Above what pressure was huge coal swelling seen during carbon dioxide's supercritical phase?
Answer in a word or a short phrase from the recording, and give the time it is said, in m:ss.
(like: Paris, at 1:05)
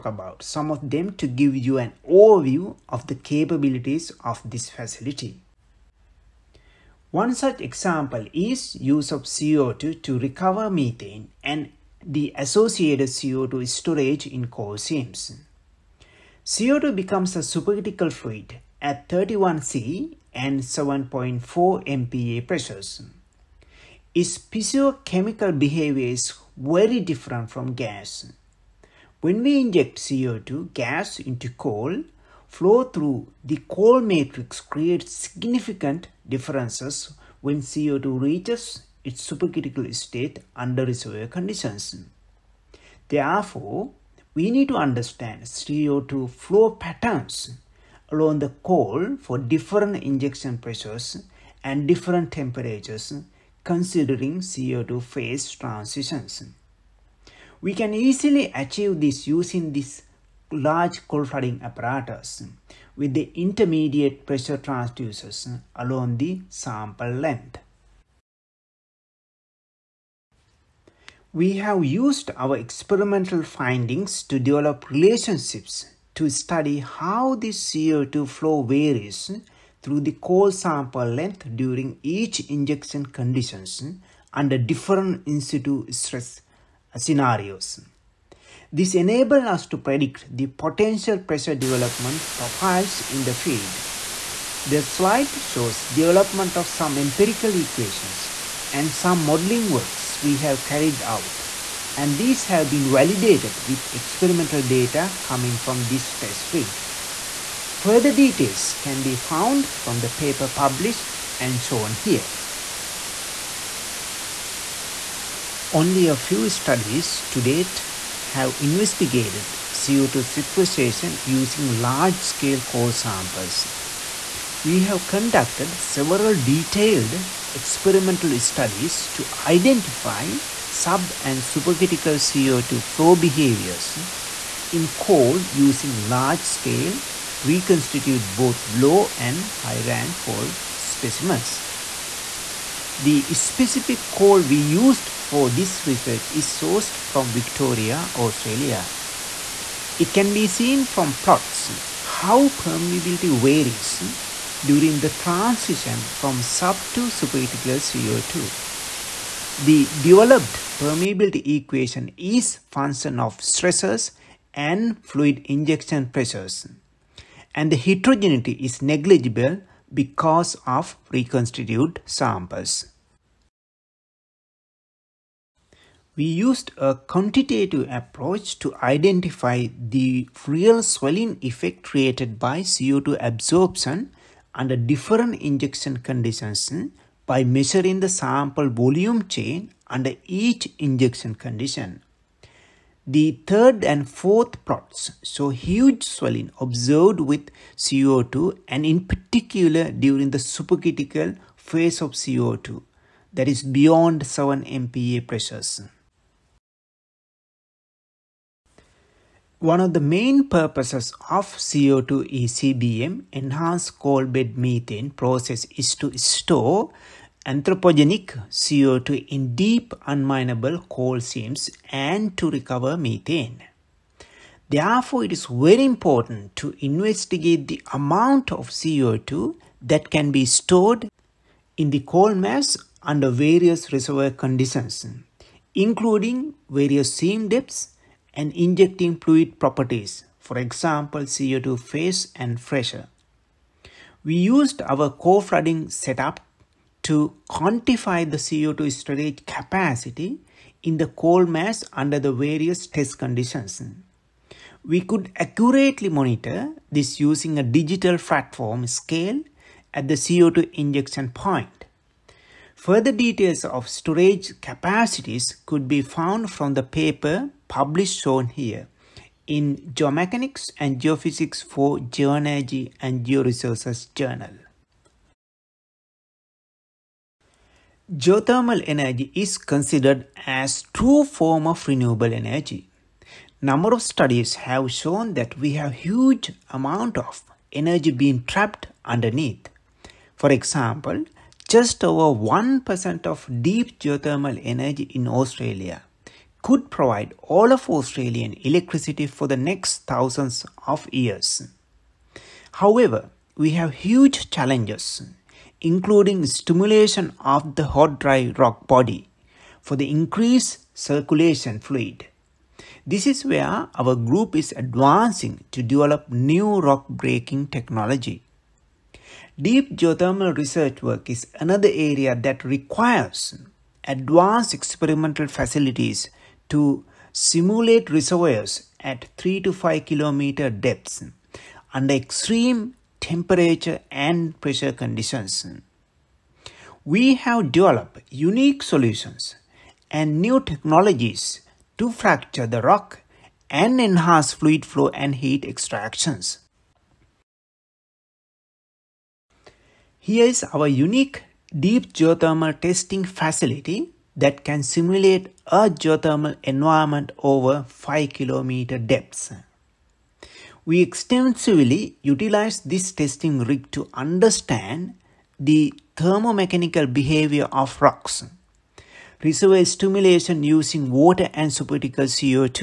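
7 MPa, at 3:24.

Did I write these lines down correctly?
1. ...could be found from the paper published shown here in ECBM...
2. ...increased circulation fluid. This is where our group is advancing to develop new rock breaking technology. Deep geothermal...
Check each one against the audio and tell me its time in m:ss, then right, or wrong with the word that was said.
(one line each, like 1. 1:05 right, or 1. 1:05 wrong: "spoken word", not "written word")
1. 4:25 wrong: "Geomechanics", not "ECBM"
2. 5:10 right.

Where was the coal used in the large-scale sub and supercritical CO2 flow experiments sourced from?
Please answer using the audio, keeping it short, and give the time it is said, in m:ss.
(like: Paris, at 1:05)
Victoria, Australia, at 2:27.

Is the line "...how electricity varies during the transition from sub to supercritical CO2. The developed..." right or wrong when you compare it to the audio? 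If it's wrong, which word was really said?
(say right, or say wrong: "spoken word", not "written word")
wrong: "permeability", not "electricity".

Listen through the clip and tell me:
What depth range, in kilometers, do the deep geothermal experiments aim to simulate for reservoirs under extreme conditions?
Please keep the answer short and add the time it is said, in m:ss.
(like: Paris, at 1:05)
3 to 5 kilometers, at 5:29.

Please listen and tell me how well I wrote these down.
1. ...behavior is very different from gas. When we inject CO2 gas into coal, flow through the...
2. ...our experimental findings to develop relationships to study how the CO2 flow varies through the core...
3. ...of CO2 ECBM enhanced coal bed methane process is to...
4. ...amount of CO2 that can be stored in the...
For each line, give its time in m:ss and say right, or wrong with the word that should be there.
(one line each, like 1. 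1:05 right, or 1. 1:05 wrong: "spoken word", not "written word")
1. 0:25 right
2. 1:12 right
3. 3:31 right
4. 3:47 right.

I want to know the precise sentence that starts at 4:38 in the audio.
Geothermal energy is considered as true form of renewable energy.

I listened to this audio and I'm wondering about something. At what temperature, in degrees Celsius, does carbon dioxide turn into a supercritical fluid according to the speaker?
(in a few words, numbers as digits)
31 C.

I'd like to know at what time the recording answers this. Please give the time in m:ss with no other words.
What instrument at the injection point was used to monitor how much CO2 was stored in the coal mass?
4:17.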